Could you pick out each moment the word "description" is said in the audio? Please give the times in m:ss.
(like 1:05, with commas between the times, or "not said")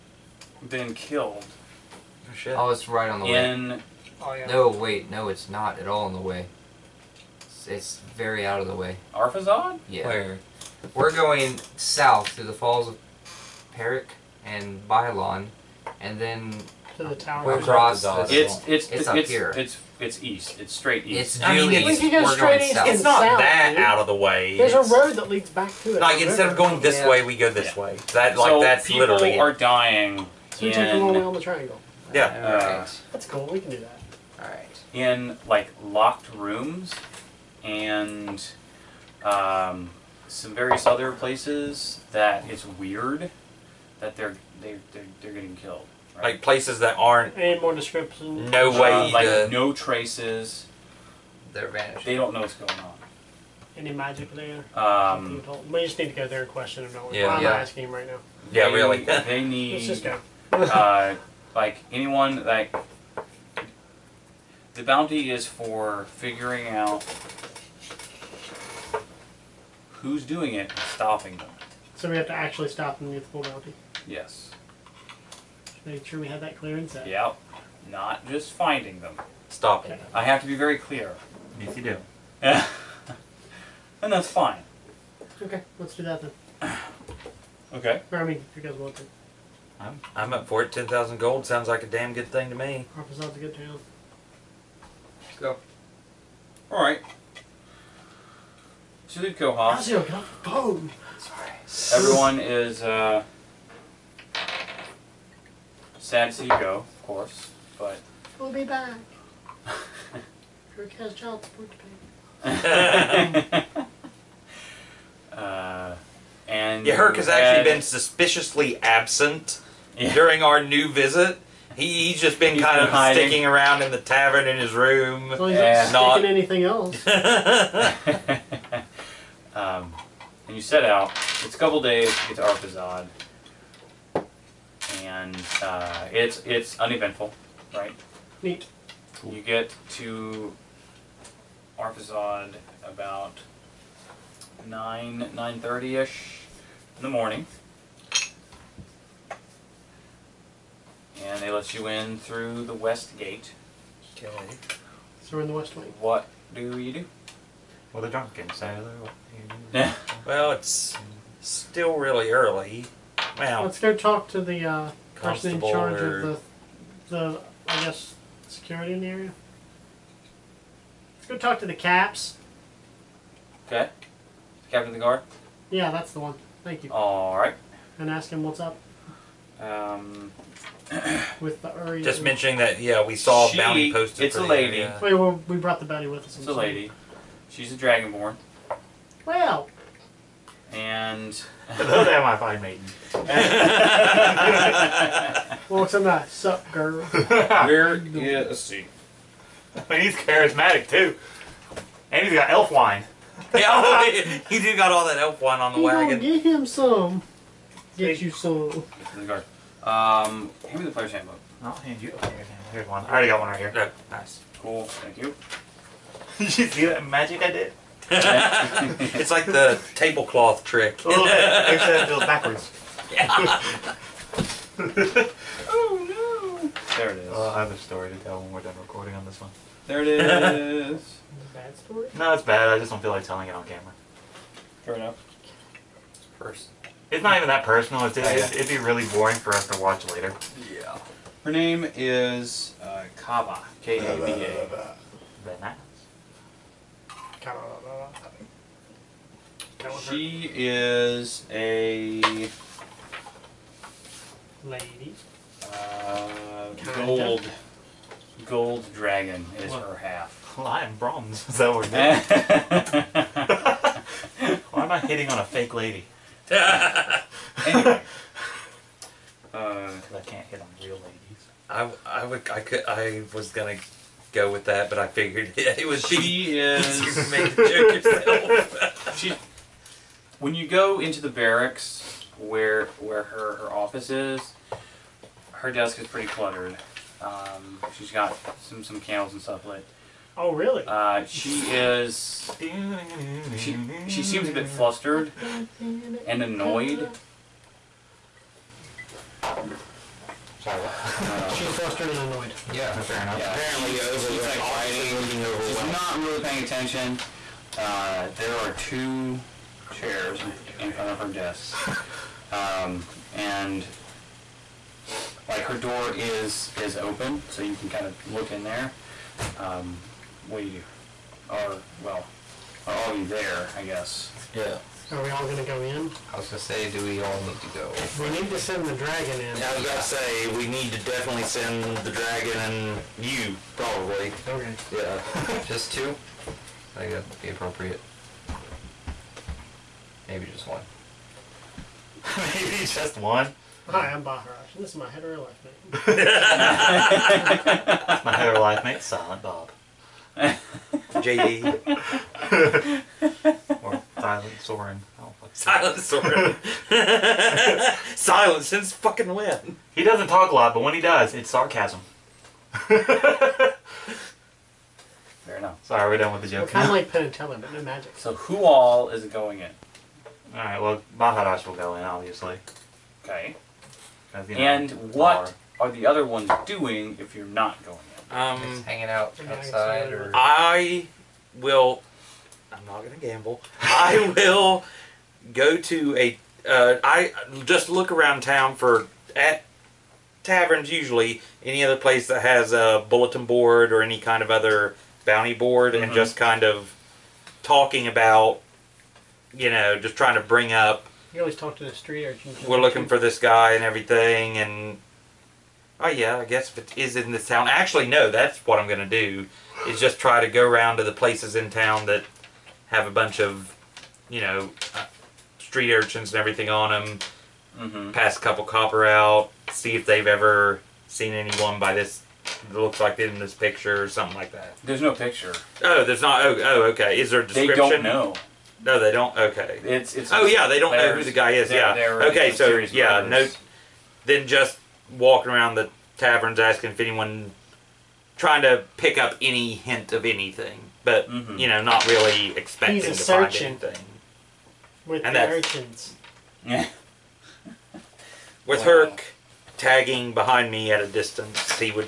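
0:47, 7:07.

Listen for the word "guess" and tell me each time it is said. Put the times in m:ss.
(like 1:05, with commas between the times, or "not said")
2:47, 5:23, 6:46.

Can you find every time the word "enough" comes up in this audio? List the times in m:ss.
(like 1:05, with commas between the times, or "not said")
3:54, 5:03, 6:05.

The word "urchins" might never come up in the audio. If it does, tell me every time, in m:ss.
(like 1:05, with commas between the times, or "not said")
6:42, 6:55, 7:25.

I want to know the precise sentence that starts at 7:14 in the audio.
Then just walking around the taverns asking if anyone, trying to pick up any hint of anything, but mm-hmm.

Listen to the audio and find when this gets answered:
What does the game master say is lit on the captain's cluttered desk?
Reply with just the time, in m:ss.
4:49.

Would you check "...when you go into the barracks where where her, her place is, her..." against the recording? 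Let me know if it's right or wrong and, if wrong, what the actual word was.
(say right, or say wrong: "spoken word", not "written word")
wrong: "office", not "place".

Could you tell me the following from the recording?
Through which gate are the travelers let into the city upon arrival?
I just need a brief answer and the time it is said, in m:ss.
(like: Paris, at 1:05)
West gate, at 2:32.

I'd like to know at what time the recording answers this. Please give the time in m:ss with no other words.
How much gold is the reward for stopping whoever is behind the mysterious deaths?
1:30.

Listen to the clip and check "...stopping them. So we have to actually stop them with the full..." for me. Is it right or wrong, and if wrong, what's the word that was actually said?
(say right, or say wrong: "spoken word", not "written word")
right.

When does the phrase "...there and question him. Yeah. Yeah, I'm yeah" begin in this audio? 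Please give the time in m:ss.
0:56.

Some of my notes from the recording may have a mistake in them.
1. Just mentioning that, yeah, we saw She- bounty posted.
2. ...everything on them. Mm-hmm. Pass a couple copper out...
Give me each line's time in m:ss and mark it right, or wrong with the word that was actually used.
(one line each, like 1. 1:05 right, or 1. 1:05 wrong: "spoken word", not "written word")
1. 3:02 right
2. 6:56 right.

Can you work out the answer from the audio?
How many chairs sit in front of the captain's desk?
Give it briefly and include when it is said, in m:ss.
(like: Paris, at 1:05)
2, at 5:08.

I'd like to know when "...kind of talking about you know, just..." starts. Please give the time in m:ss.
6:36.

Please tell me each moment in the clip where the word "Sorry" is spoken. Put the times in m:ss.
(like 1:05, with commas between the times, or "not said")
1:41, 5:00, 6:05.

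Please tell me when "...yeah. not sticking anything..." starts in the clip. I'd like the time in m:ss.
2:05.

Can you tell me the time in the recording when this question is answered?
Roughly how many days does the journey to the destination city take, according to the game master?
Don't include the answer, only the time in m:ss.
2:11.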